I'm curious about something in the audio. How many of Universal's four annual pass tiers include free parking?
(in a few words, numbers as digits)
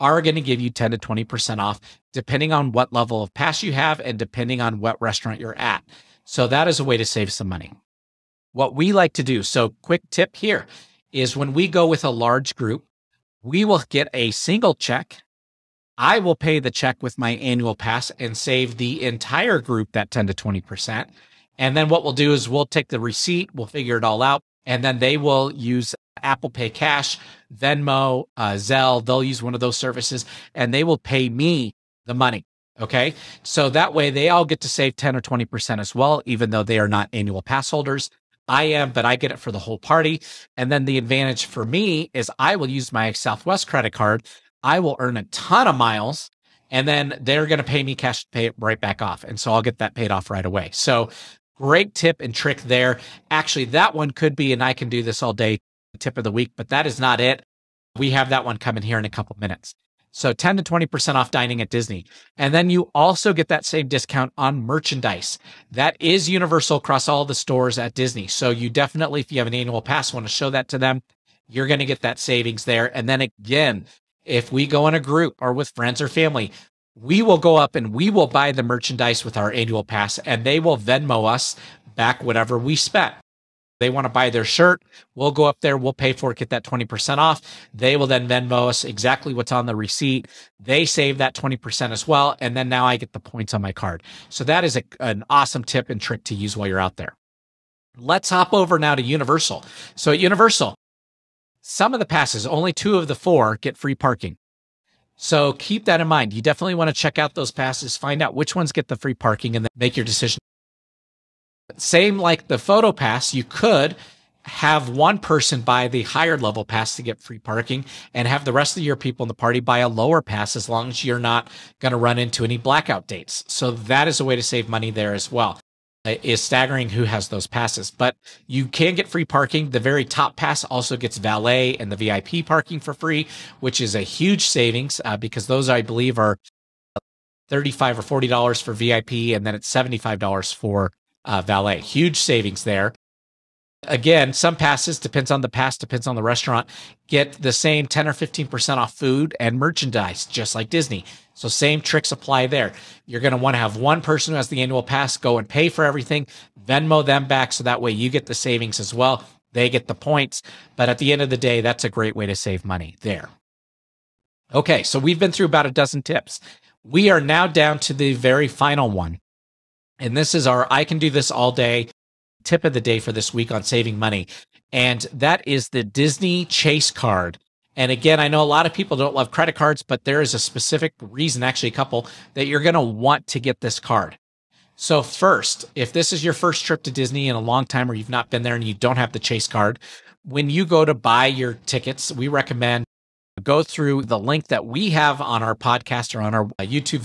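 2.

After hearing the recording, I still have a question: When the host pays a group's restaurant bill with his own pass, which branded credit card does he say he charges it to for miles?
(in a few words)
Southwest.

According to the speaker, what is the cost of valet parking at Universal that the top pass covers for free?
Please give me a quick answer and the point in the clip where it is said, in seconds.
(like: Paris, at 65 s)
$75, at 139 s.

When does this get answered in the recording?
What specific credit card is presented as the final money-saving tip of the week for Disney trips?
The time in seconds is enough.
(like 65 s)
175 s.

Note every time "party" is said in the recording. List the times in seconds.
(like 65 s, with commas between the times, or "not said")
39 s, 119 s.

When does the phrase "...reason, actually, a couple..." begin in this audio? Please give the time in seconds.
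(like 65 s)
181 s.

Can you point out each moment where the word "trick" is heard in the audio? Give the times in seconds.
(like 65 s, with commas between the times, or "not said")
52 s, 95 s, 151 s.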